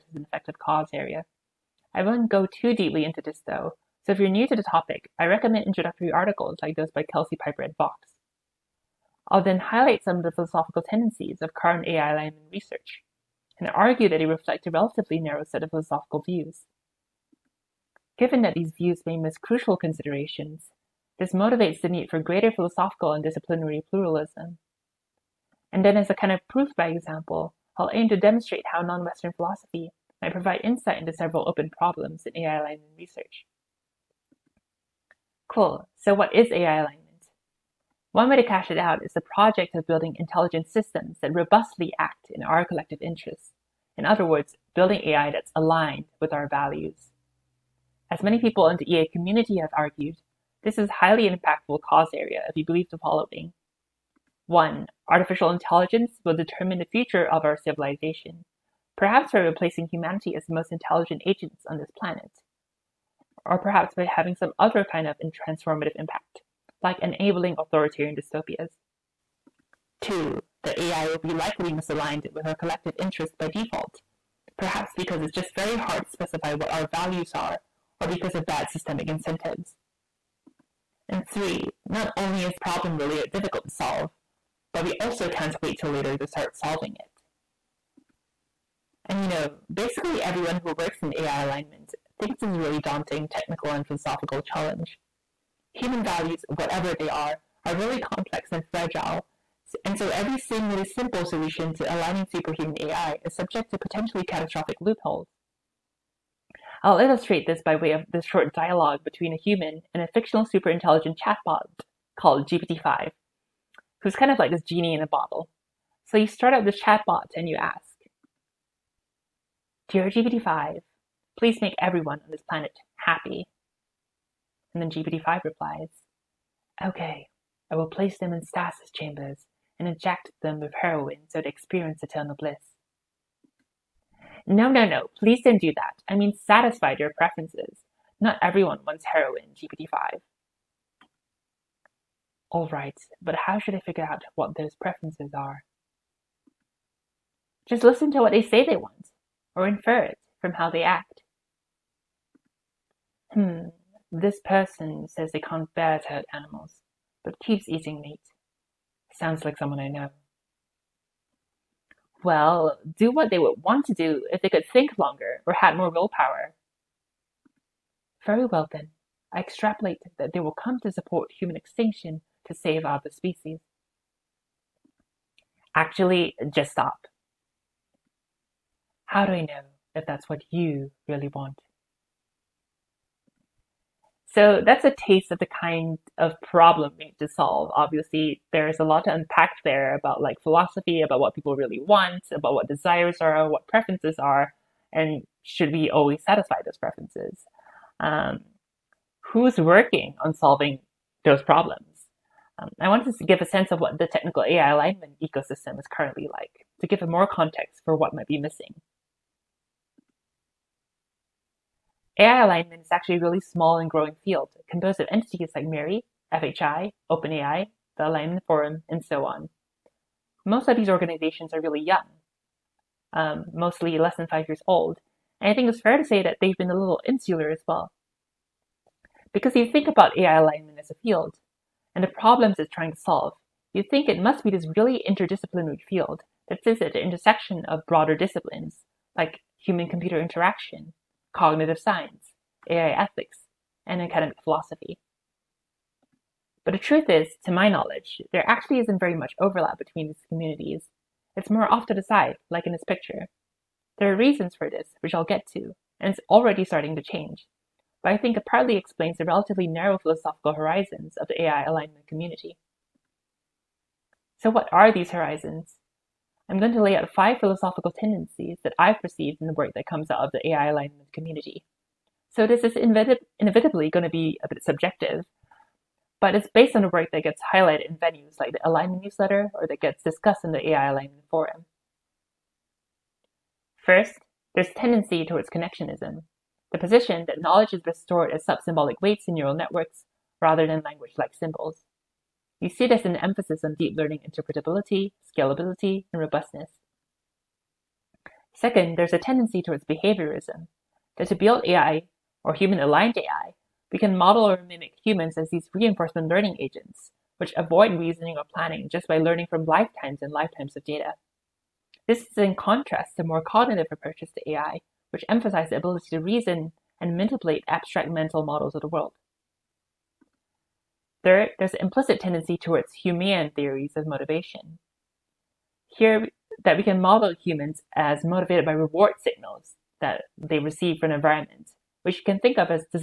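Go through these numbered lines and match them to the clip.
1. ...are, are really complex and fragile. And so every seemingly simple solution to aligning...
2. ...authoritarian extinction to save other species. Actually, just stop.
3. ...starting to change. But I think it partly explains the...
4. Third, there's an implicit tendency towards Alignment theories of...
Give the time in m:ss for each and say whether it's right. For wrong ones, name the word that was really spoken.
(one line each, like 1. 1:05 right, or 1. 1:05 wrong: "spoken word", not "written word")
1. 1:37 right
2. 2:51 wrong: "human", not "authoritarian"
3. 4:16 right
4. 5:21 wrong: "Humean", not "Alignment".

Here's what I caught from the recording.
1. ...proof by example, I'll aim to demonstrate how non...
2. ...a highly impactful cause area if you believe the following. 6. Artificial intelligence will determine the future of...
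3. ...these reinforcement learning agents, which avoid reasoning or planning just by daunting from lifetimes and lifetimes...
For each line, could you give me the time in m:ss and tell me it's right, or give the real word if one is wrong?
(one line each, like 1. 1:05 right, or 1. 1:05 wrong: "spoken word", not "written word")
1. 0:26 right
2. 0:50 wrong: "1", not "6"
3. 5:05 wrong: "learning", not "daunting".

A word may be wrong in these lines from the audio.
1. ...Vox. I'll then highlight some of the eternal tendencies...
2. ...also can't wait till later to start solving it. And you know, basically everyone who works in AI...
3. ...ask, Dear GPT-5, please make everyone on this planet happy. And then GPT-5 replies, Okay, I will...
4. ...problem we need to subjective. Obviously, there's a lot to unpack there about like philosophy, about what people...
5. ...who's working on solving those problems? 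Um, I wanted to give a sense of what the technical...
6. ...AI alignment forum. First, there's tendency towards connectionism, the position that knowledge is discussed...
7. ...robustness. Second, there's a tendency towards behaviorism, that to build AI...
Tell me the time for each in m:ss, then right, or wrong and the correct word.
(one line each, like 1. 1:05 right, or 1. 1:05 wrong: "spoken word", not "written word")
1. 0:07 wrong: "philosophical", not "eternal"
2. 1:25 right
3. 1:57 right
4. 3:06 wrong: "solve", not "subjective"
5. 3:19 right
6. 4:40 wrong: "restored", not "discussed"
7. 4:56 right.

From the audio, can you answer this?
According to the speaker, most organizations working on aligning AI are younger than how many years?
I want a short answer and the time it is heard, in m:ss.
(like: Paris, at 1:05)
5, at 3:44.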